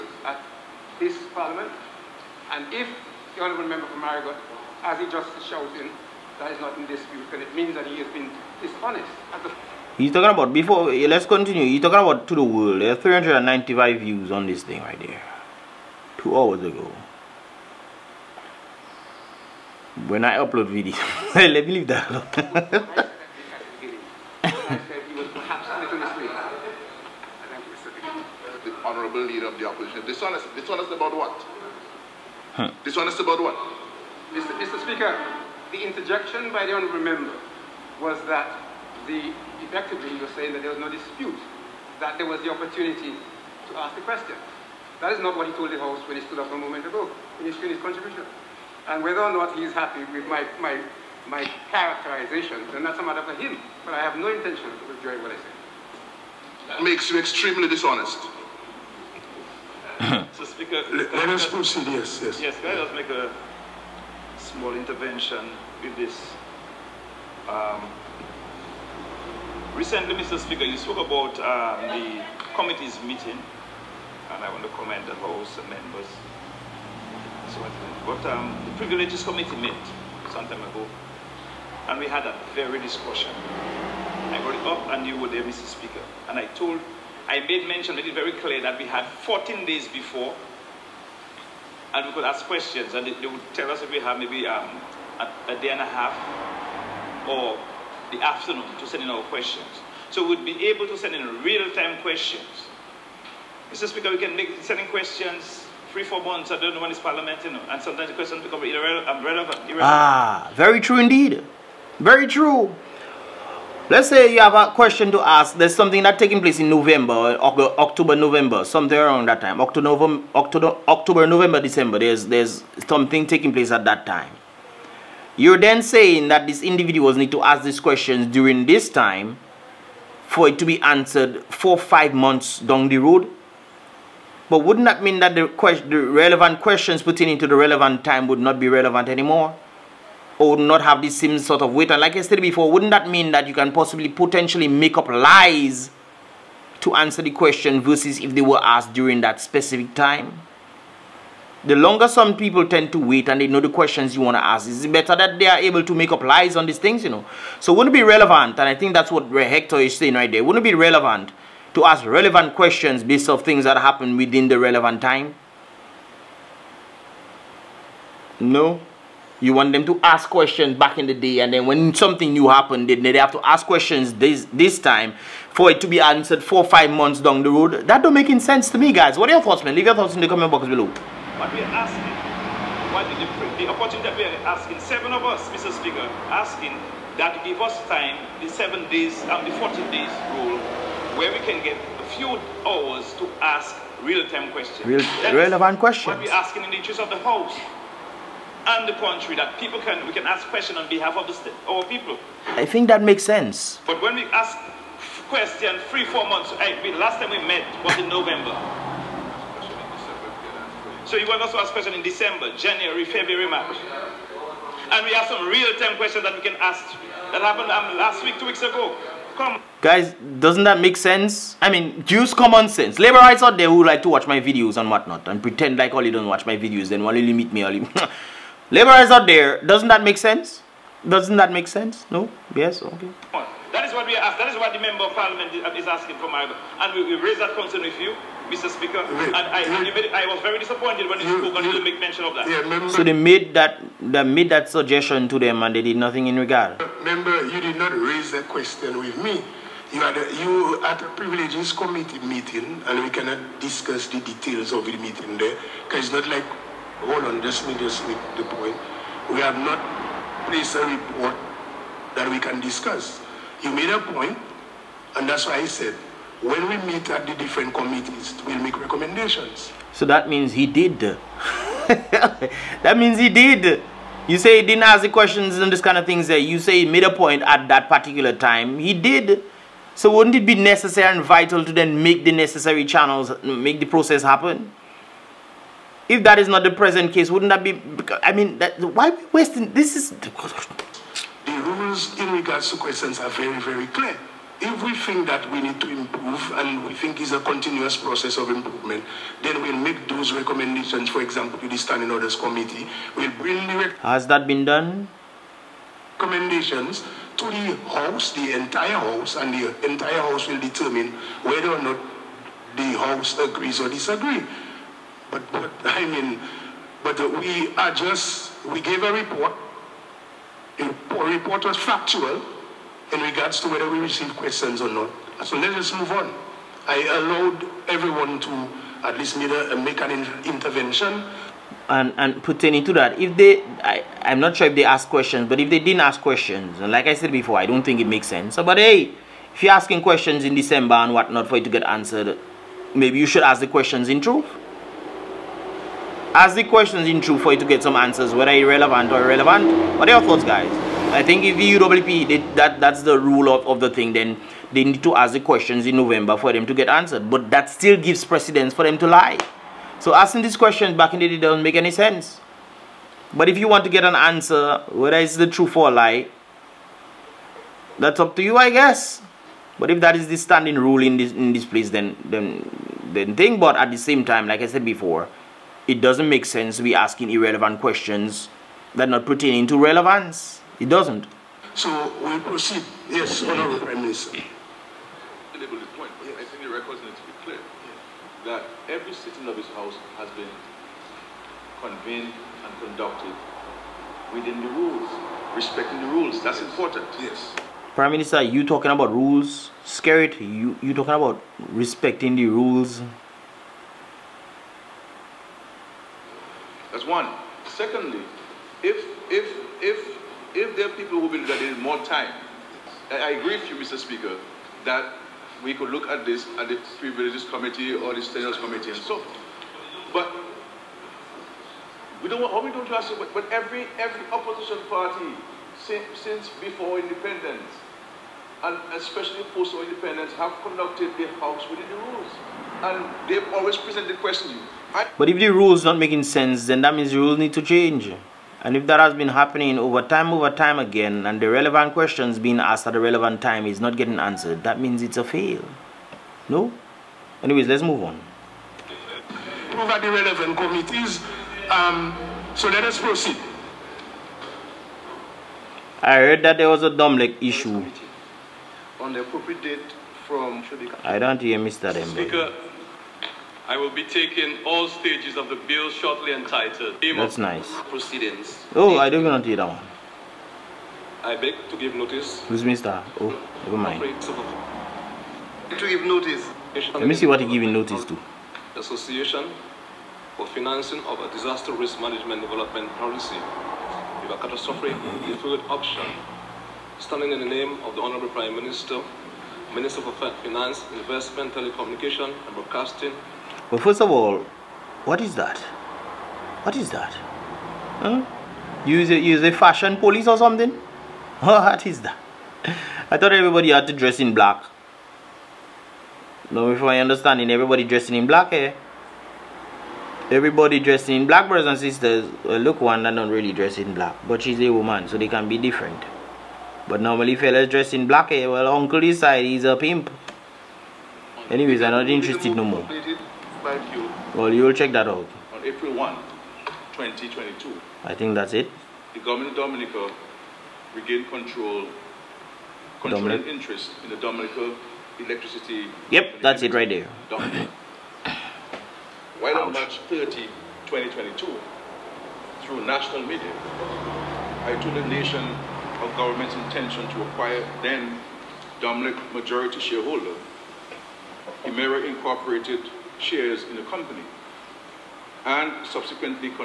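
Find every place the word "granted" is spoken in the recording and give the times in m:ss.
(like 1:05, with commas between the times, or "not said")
not said.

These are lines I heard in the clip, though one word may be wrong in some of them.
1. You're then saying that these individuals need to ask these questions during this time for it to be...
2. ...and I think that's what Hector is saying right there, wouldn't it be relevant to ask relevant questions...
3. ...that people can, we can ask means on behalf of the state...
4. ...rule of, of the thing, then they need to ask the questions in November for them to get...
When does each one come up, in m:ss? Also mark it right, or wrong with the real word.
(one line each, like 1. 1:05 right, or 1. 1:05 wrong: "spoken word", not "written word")
1. 2:05 right
2. 2:38 right
3. 3:19 wrong: "questions", not "means"
4. 5:53 right.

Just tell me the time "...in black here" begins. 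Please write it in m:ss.
8:28.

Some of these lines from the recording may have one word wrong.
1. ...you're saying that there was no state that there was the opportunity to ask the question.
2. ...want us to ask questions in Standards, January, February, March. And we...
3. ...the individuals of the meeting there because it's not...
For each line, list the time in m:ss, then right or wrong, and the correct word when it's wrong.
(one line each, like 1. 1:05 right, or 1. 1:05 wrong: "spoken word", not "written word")
1. 0:40 wrong: "dispute", not "state"
2. 3:31 wrong: "December", not "Standards"
3. 4:14 wrong: "details", not "individuals".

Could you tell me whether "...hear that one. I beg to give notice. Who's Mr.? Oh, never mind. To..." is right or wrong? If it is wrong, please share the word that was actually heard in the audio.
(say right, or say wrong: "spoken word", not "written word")
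right.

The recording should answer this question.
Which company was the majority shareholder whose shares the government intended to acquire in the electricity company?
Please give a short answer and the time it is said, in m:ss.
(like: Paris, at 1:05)
Emera Incorporated, at 9:11.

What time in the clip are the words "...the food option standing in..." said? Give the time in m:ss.
8:04.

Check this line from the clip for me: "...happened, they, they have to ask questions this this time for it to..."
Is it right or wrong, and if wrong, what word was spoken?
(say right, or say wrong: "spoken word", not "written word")
right.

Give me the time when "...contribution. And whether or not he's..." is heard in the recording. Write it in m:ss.
0:47.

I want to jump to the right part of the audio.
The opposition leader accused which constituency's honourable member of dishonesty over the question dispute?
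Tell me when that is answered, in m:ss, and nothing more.
0:04.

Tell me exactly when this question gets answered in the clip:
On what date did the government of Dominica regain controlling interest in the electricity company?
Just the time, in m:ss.
8:45.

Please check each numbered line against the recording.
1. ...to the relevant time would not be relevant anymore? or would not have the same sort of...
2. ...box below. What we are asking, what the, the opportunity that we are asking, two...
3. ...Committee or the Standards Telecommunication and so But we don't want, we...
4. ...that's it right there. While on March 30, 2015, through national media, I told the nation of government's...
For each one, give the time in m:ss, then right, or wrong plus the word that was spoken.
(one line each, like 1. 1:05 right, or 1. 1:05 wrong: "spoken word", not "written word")
1. 2:17 right
2. 3:00 wrong: "seven", not "two"
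3. 6:57 wrong: "Committee", not "Telecommunication"
4. 8:56 wrong: "2022", not "2015".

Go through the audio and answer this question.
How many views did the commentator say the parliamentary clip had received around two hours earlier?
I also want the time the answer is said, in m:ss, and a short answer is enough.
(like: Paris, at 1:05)
395, at 0:12.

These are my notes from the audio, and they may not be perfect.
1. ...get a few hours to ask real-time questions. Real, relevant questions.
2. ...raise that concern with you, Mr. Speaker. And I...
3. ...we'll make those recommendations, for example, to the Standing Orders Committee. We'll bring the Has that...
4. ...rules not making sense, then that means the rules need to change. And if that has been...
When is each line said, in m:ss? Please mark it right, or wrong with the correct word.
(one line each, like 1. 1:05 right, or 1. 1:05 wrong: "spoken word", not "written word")
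1. 3:11 right
2. 3:57 right
3. 4:59 right
4. 7:15 right.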